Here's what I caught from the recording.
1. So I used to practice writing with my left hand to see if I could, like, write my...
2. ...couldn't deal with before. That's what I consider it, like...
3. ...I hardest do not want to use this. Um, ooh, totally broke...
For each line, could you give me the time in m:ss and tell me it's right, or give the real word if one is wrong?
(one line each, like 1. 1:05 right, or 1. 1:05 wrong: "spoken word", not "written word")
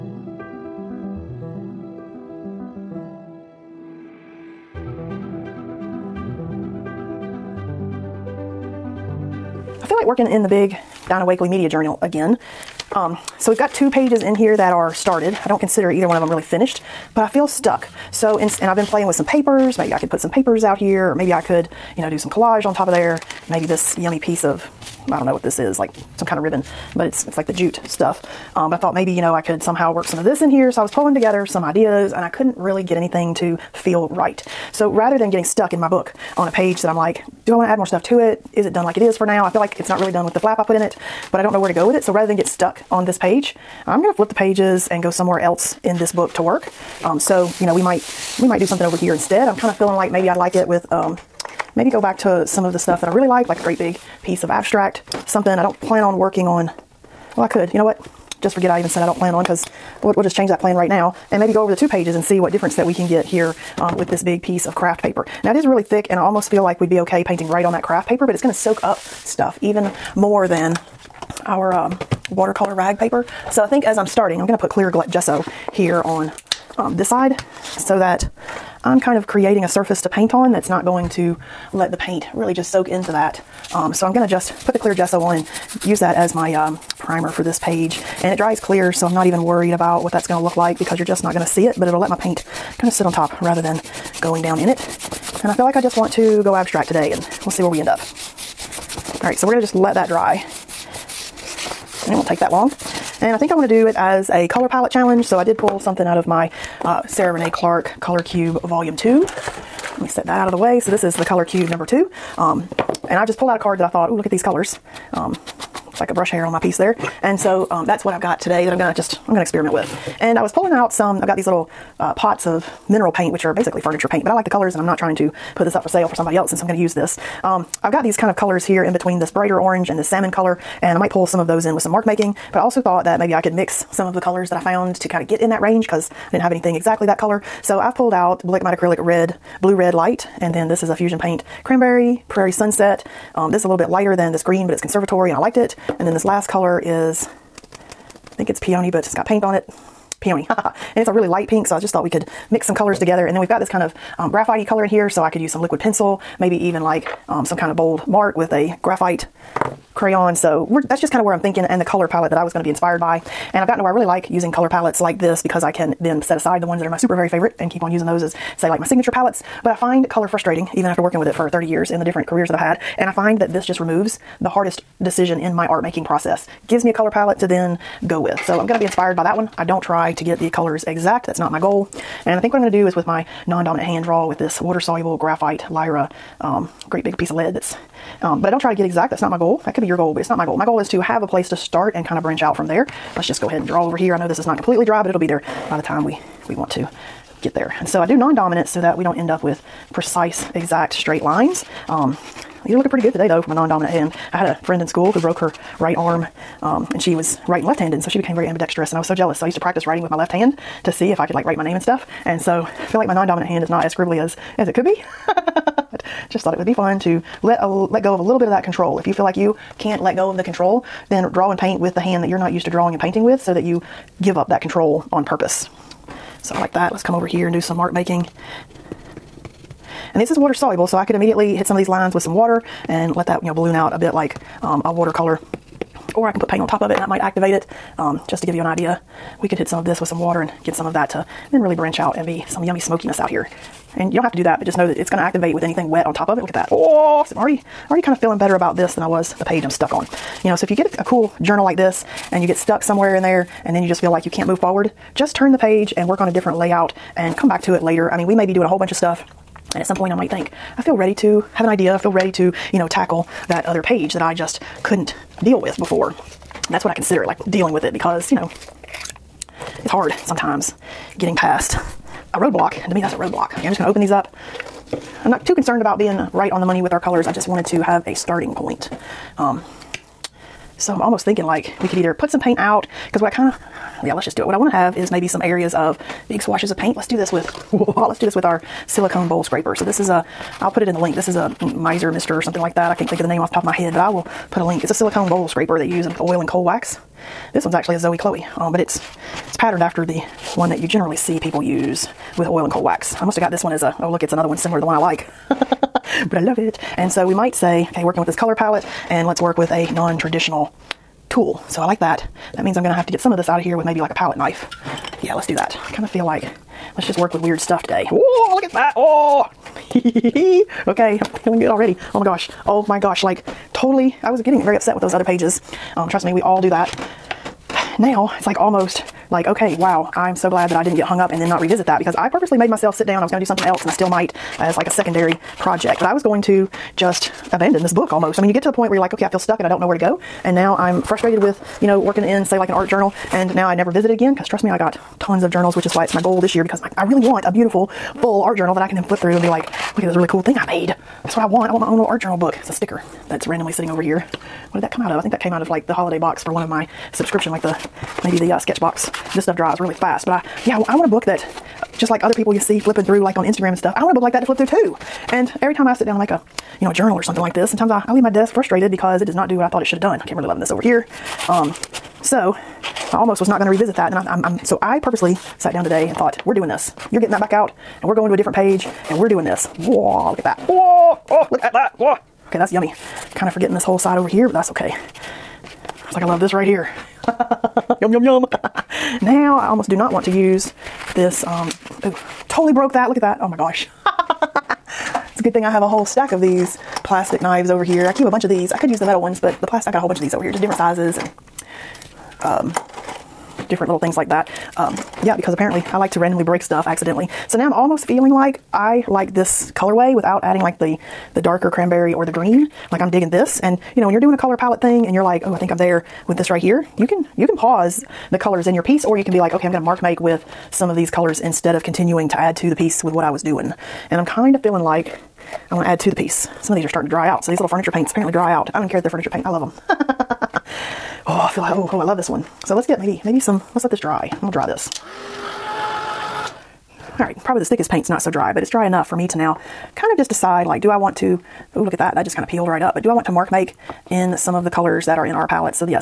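1. 3:29 right
2. 4:24 right
3. 6:29 wrong: "almost", not "hardest".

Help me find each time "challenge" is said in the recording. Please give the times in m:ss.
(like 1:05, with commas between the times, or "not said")
1:44.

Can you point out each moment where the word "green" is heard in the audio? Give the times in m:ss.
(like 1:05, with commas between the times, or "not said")
2:24, 6:52.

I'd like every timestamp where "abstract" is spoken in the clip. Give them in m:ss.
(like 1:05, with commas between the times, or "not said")
0:54, 1:36.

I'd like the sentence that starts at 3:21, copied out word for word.
Um, these are looking pretty good today, though, for my non-dominant hand.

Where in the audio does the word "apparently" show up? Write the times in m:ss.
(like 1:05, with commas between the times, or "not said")
6:45, 7:08.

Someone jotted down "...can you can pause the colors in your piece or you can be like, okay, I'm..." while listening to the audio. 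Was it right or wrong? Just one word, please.
right.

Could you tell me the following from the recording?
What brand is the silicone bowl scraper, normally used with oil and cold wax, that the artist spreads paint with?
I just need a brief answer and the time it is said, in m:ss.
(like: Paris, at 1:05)
Zoe Chloe, at 4:57.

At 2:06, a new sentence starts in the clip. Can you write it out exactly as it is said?
And so I'm gonna use this.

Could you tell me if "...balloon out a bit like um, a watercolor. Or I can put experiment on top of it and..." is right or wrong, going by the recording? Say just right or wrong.
wrong.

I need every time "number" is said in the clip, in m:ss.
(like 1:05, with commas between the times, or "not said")
1:51.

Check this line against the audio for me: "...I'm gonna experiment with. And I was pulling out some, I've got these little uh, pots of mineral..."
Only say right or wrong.
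right.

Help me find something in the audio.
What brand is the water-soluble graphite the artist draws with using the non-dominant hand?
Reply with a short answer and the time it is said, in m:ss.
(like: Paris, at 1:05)
Lyra, at 3:05.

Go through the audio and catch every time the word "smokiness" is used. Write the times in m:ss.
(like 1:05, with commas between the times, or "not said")
4:02.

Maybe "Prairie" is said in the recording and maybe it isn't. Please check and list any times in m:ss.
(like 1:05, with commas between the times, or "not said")
2:22.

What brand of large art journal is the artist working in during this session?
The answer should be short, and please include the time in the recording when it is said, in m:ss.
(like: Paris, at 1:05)
Dina Wakley Media Journal, at 0:11.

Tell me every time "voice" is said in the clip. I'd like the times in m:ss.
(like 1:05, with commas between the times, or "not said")
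not said.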